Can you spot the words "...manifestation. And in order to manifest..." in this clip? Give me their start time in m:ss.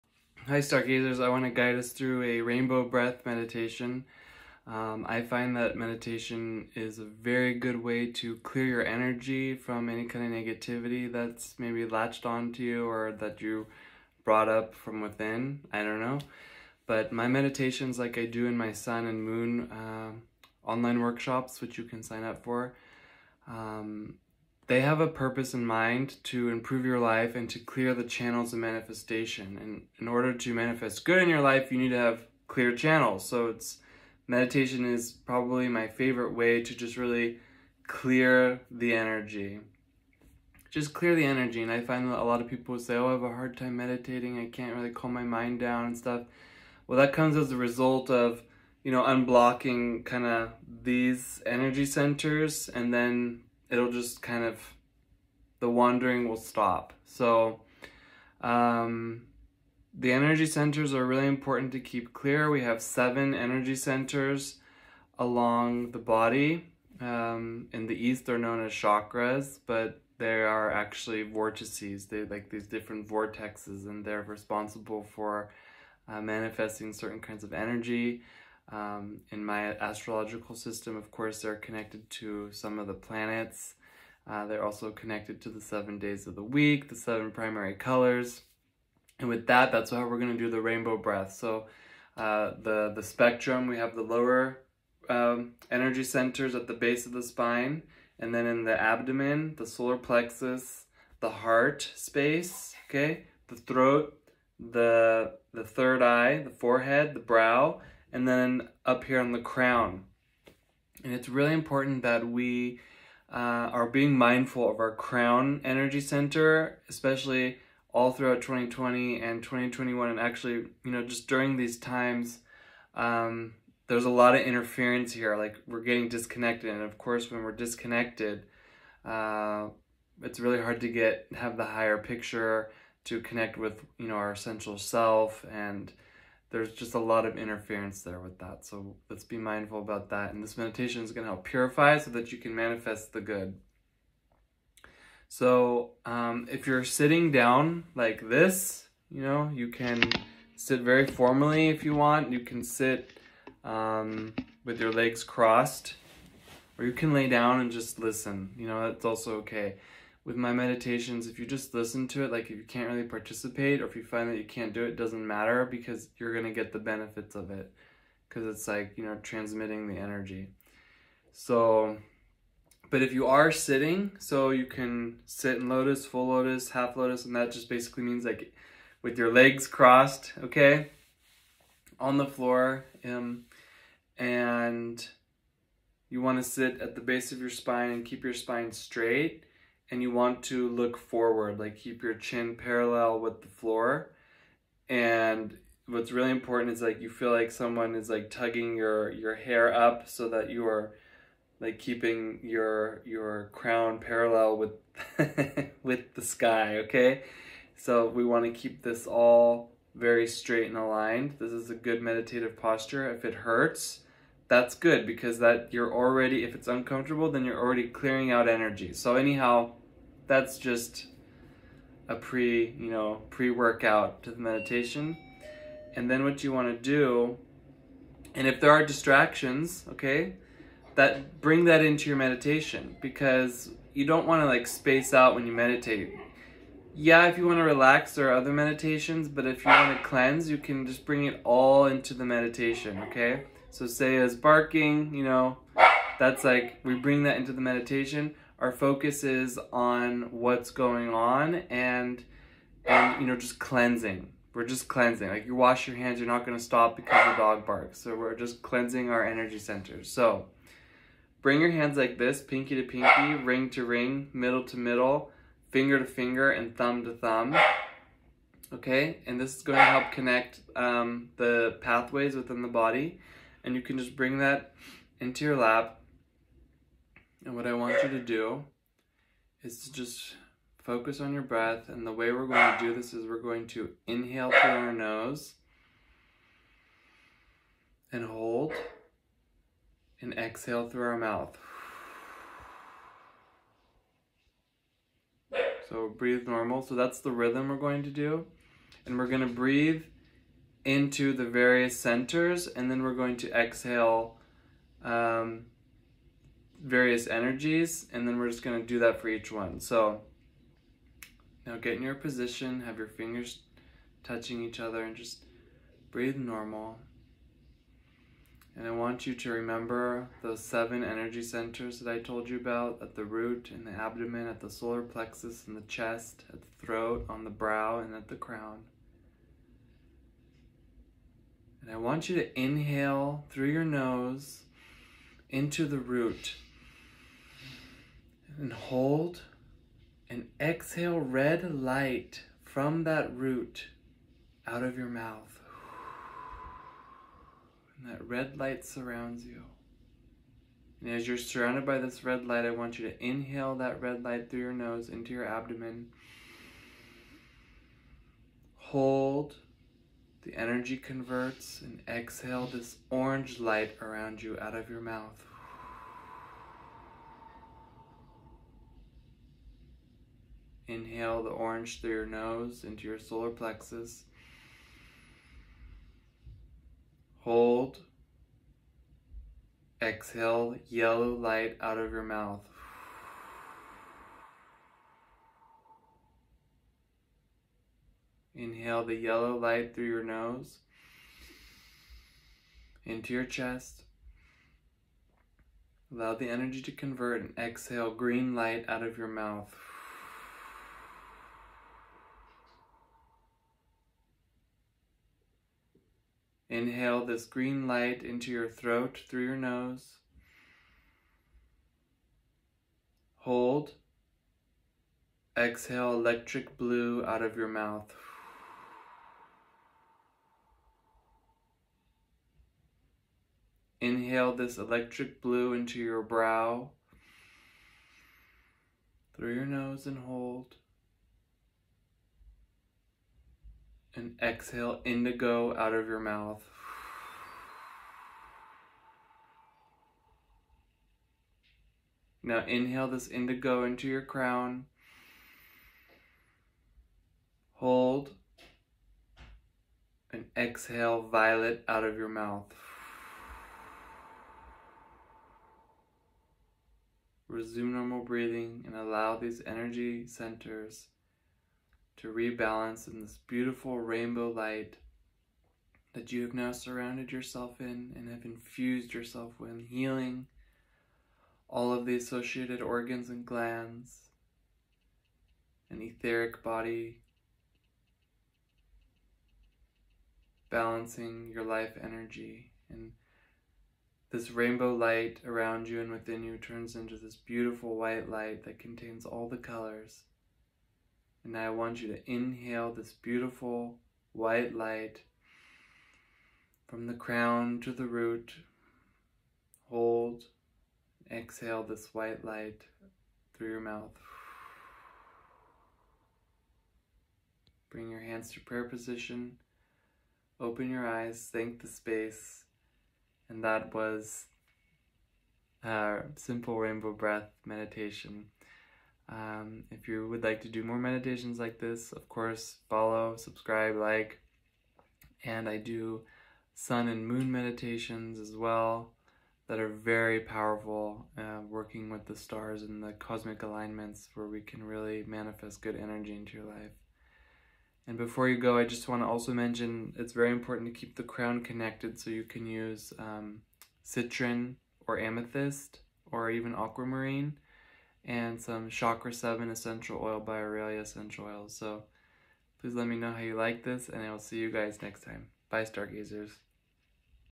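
0:28.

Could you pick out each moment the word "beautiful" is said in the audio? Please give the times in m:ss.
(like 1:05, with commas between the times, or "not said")
7:43, 8:07, 8:13.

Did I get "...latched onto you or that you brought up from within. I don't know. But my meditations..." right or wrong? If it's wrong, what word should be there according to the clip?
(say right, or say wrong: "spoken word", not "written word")
right.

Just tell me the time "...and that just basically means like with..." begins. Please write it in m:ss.
2:57.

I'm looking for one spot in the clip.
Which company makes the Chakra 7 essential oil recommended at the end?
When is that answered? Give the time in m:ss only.
9:10.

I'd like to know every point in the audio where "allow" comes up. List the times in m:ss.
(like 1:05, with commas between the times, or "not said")
6:36, 7:38.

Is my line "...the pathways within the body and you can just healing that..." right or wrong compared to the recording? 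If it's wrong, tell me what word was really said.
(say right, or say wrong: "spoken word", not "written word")
wrong: "bring", not "healing".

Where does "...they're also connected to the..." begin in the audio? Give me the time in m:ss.
1:24.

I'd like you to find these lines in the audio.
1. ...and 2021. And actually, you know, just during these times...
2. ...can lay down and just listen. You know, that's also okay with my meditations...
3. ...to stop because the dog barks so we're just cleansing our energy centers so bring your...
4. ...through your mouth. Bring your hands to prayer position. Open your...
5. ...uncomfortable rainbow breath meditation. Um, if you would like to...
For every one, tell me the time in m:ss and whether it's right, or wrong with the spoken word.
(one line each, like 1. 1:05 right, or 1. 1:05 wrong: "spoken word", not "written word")
1. 1:59 right
2. 2:36 right
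3. 4:16 right
4. 8:23 right
5. 8:36 wrong: "simple", not "uncomfortable".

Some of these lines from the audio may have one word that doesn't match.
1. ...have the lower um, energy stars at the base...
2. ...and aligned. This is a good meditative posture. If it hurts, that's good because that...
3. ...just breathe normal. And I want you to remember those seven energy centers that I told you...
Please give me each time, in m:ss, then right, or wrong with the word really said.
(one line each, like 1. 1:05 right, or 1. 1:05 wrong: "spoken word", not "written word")
1. 1:33 wrong: "centers", not "stars"
2. 3:30 right
3. 5:15 right.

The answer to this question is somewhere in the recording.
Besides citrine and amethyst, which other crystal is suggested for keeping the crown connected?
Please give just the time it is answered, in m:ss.
9:06.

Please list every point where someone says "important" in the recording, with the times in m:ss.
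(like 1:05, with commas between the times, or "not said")
1:01, 1:51, 3:16, 9:00.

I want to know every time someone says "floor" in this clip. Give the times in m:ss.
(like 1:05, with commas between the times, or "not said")
3:02, 3:13.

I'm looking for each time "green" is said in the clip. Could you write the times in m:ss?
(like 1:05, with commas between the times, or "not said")
6:38, 6:47.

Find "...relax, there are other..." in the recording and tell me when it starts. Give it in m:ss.
3:57.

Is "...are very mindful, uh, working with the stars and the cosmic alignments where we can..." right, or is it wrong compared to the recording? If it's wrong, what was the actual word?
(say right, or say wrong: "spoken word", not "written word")
wrong: "powerful", not "mindful".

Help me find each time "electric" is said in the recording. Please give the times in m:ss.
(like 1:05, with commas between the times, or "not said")
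6:56, 7:04.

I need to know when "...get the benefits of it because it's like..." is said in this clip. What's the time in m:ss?
2:46.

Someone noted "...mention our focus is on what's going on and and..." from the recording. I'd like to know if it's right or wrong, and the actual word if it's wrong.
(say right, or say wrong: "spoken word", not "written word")
wrong: "meditation", not "mention".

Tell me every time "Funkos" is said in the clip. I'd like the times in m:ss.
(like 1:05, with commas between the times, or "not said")
not said.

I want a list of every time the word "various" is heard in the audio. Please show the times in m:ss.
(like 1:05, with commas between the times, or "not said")
5:01, 5:06.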